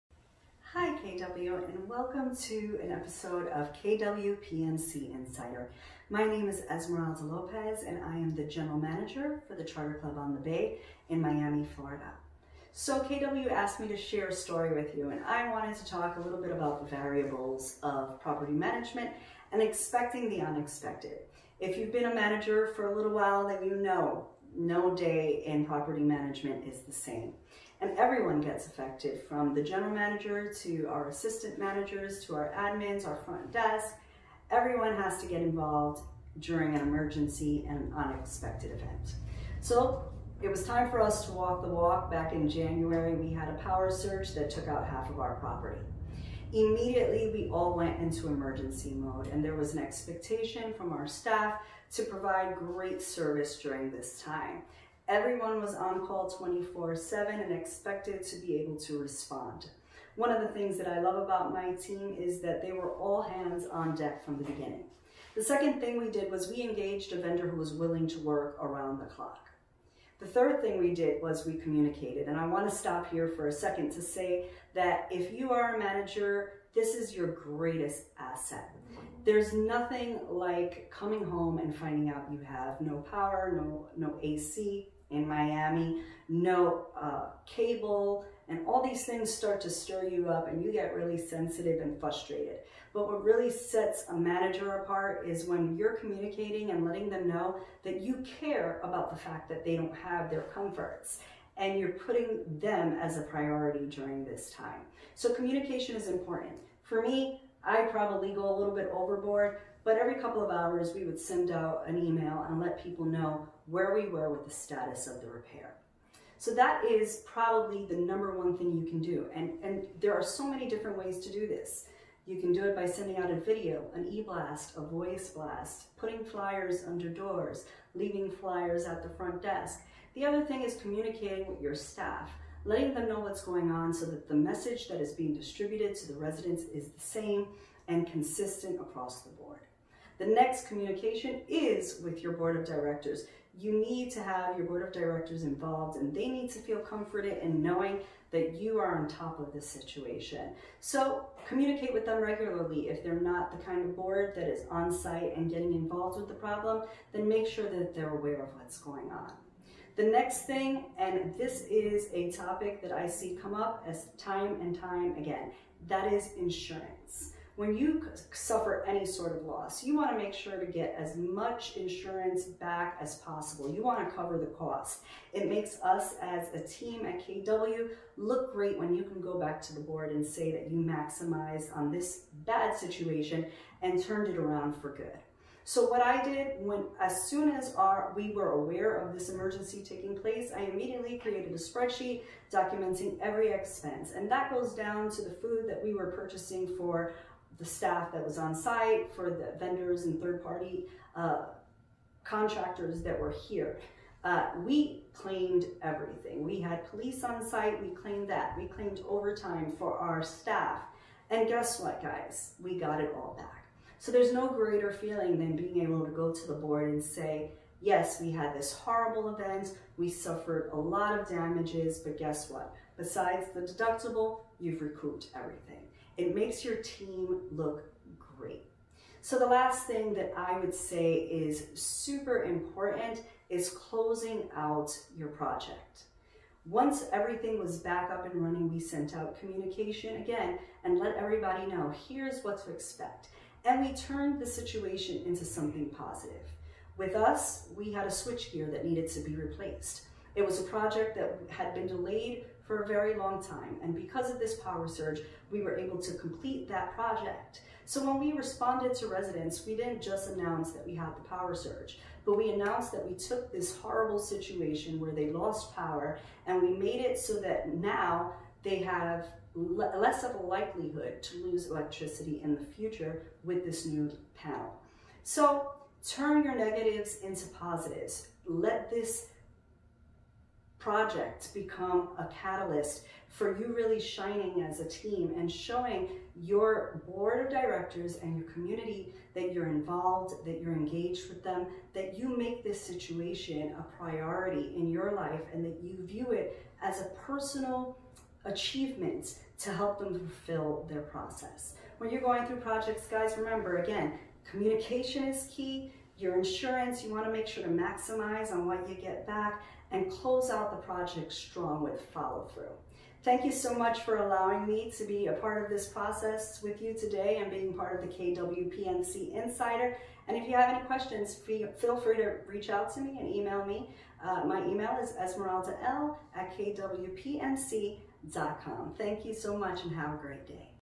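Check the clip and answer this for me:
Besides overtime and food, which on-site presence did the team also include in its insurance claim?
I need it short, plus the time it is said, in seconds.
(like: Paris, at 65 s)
Police, at 206 s.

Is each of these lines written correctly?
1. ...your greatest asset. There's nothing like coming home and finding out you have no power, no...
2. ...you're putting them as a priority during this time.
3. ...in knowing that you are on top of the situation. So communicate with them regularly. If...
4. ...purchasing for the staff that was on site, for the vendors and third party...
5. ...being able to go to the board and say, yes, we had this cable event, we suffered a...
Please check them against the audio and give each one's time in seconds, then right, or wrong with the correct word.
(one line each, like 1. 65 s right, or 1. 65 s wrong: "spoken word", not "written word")
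1. 77 s right
2. 101 s right
3. 147 s right
4. 196 s right
5. 215 s wrong: "horrible", not "cable".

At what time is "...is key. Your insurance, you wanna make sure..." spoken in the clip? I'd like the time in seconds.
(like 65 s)
305 s.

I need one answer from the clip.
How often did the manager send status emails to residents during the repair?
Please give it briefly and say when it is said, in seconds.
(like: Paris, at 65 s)
Every couple of hours, at 109 s.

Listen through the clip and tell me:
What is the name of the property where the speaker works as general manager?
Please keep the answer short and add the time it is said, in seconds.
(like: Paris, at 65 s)
Charter Club on the Bay, at 9 s.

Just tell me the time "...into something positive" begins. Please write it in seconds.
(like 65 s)
245 s.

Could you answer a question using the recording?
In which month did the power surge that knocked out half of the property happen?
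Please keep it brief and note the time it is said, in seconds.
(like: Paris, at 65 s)
January, at 42 s.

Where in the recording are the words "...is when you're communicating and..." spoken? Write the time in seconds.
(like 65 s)
95 s.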